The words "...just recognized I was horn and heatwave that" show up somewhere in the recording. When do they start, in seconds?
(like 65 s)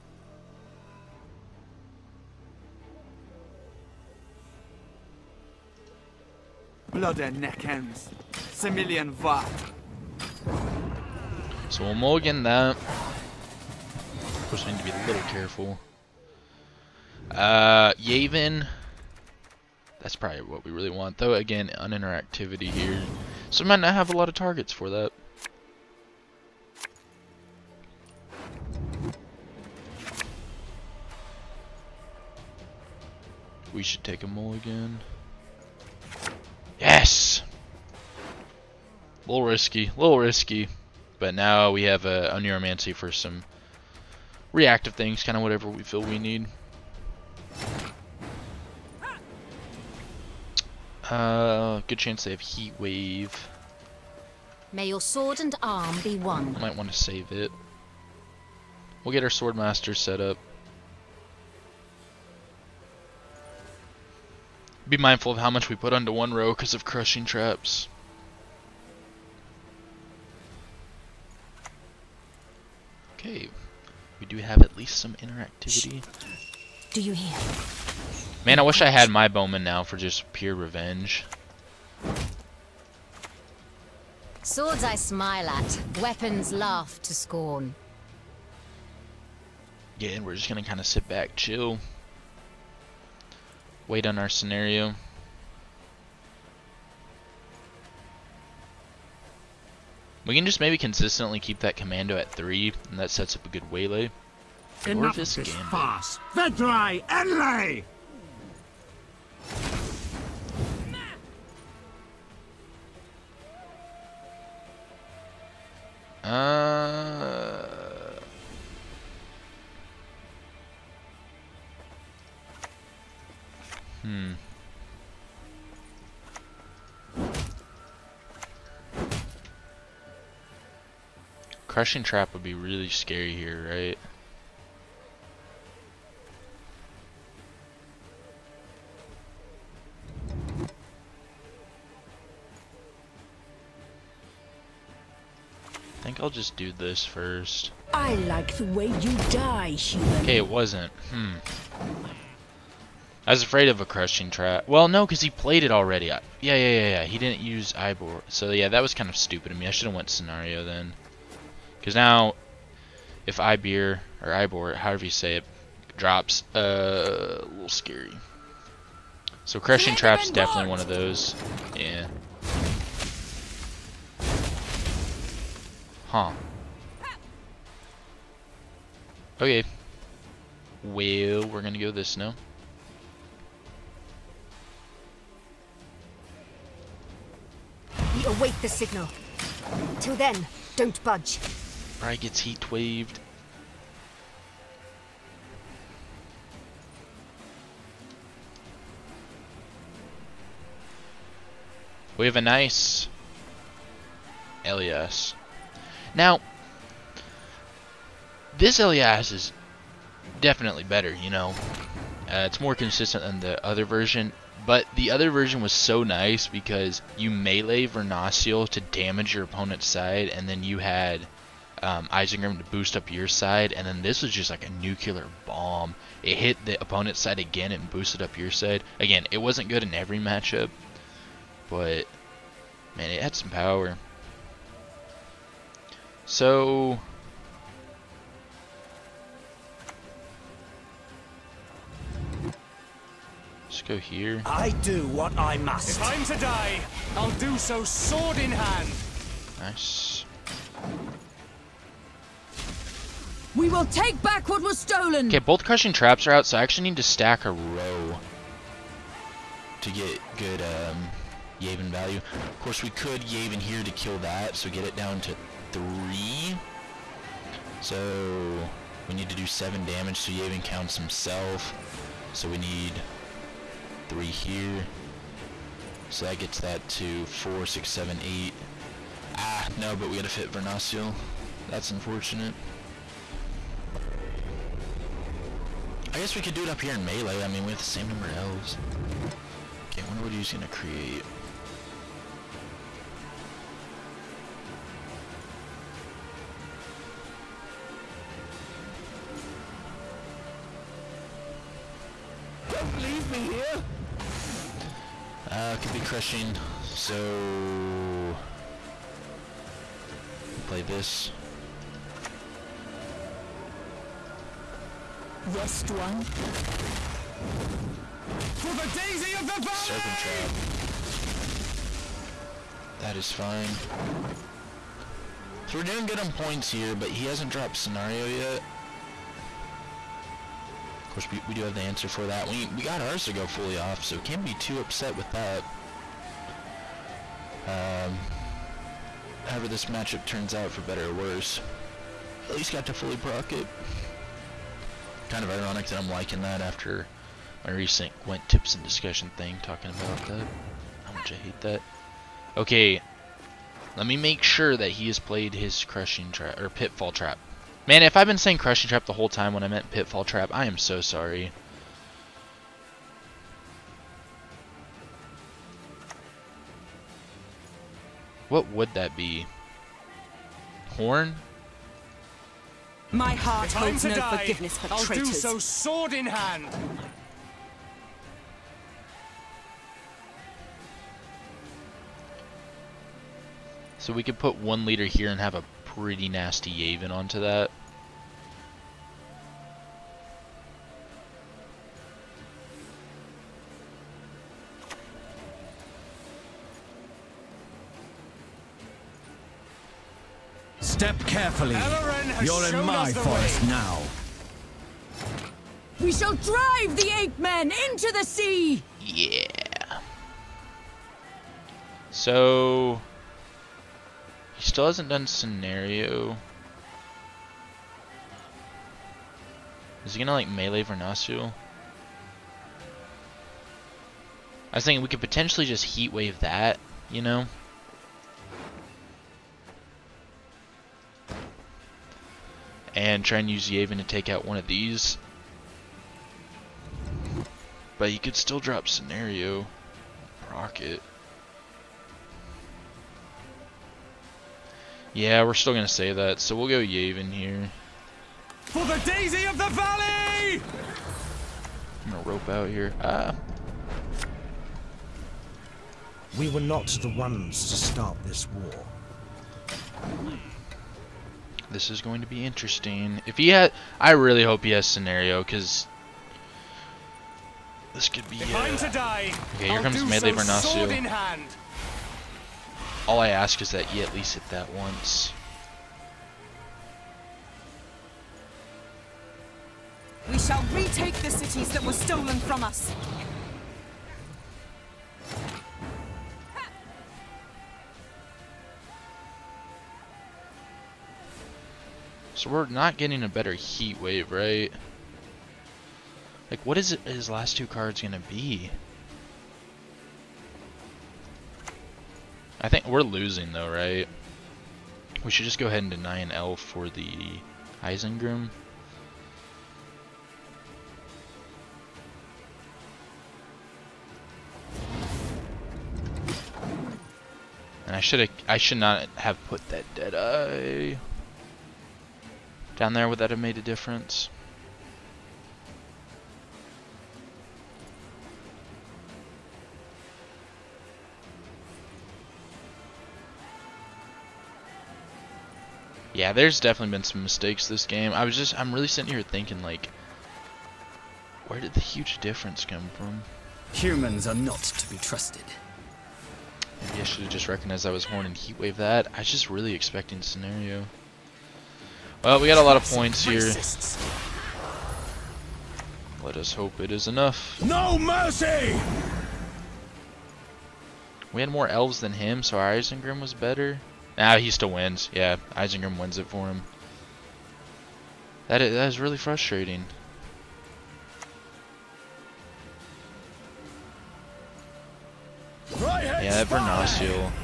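547 s.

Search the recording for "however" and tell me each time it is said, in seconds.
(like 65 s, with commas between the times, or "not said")
164 s, 339 s.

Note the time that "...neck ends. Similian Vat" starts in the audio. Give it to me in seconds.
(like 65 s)
7 s.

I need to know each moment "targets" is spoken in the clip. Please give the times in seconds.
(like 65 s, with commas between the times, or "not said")
24 s.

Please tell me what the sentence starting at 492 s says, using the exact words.
So we're not getting a better heat wave, right?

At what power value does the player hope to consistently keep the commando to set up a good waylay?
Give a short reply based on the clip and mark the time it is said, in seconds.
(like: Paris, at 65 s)
3, at 102 s.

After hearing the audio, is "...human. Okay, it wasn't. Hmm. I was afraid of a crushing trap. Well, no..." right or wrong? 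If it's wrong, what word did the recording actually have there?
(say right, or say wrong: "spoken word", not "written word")
right.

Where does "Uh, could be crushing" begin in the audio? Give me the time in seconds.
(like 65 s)
305 s.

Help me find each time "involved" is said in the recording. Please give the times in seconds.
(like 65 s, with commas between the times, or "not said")
not said.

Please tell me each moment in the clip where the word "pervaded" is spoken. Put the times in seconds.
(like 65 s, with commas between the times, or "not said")
not said.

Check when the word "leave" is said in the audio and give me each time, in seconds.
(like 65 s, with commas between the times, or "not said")
302 s.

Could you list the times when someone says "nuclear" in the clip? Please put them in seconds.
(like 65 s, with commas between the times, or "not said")
224 s.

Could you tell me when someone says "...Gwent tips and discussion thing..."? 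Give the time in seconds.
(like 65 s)
348 s.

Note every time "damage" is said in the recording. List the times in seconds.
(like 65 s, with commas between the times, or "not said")
218 s, 269 s.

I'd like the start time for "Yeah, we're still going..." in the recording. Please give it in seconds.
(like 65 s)
445 s.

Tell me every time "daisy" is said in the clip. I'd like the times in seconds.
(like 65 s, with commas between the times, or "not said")
318 s, 449 s.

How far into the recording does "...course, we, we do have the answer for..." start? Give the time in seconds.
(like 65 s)
331 s.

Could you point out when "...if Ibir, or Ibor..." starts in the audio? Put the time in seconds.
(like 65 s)
163 s.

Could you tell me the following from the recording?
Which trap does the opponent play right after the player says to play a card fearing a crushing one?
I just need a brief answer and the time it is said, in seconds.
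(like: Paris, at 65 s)
Serpent trap, at 319 s.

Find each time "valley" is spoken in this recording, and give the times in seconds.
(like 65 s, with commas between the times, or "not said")
319 s, 449 s.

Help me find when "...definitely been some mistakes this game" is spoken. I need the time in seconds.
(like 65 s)
536 s.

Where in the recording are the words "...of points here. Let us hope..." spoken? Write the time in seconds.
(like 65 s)
552 s.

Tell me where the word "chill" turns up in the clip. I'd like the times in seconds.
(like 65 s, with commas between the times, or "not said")
91 s.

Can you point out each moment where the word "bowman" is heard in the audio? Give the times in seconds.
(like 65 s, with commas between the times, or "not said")
79 s.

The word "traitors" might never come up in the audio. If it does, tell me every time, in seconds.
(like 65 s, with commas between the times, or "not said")
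375 s.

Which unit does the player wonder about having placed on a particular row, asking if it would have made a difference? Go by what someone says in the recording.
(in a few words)
Deadeye.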